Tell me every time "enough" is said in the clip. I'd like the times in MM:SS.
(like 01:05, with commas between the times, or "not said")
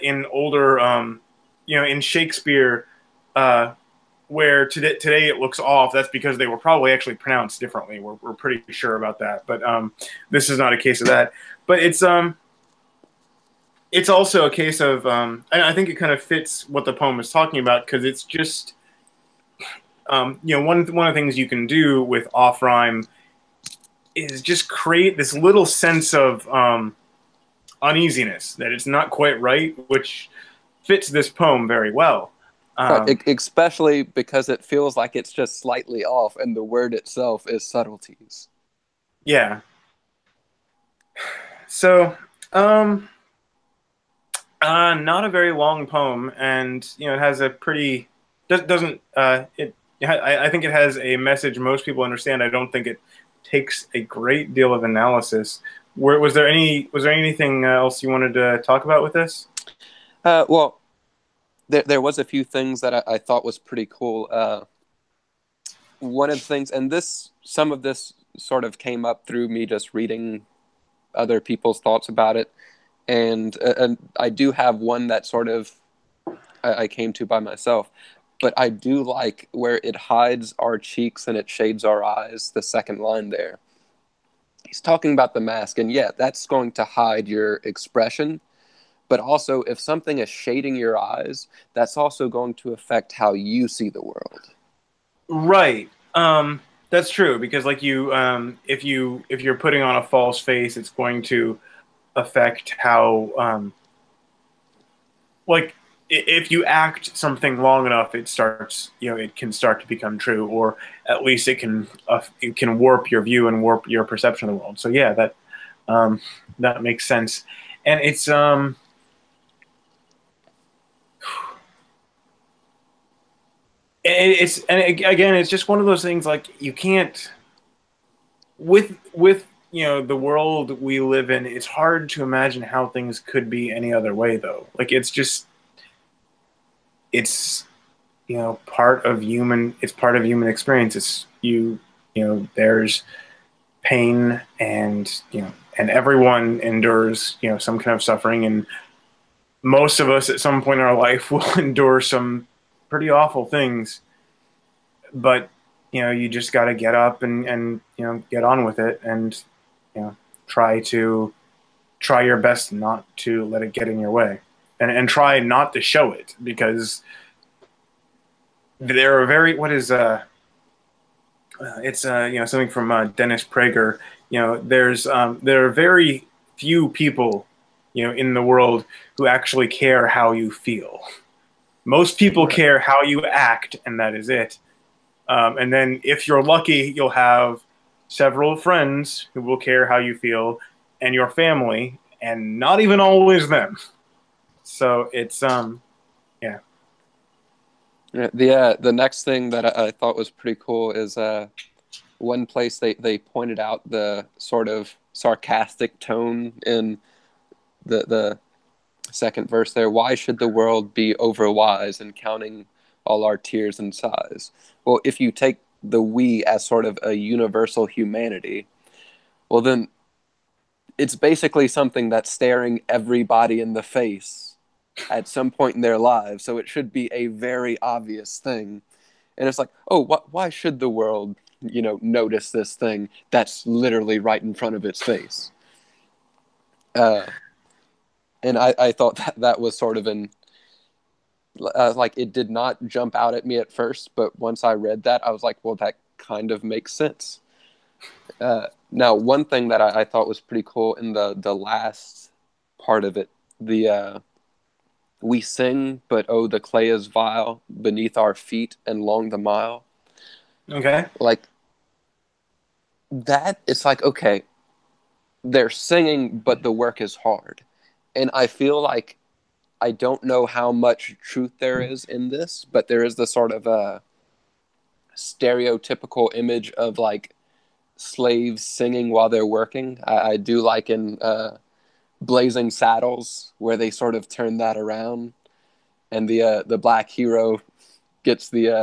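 01:47.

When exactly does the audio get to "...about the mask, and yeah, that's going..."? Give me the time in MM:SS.
01:25.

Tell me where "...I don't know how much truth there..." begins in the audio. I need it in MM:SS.
04:29.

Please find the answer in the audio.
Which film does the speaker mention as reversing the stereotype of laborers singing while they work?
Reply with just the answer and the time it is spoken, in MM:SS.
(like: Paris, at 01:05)
Blazing Saddles, at 04:42.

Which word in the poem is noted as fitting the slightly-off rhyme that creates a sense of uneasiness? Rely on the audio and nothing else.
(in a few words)
subtleties.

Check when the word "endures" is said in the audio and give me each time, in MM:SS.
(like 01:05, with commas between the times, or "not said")
02:26, 02:31.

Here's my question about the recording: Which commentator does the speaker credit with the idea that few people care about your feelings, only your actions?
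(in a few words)
Dennis Prager.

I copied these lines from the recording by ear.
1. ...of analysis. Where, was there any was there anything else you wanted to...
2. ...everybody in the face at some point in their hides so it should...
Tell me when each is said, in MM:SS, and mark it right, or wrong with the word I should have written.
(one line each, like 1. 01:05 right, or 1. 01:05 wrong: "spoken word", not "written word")
1. 00:54 right
2. 03:42 wrong: "lives", not "hides".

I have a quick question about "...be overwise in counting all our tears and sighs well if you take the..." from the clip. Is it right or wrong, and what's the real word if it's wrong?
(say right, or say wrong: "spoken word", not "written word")
right.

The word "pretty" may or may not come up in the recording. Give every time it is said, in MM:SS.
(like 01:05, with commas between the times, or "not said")
00:08, 00:47, 01:03, 02:32, 03:20, 04:10.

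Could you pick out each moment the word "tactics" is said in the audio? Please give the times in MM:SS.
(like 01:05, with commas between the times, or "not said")
not said.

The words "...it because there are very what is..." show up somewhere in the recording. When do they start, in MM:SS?
02:46.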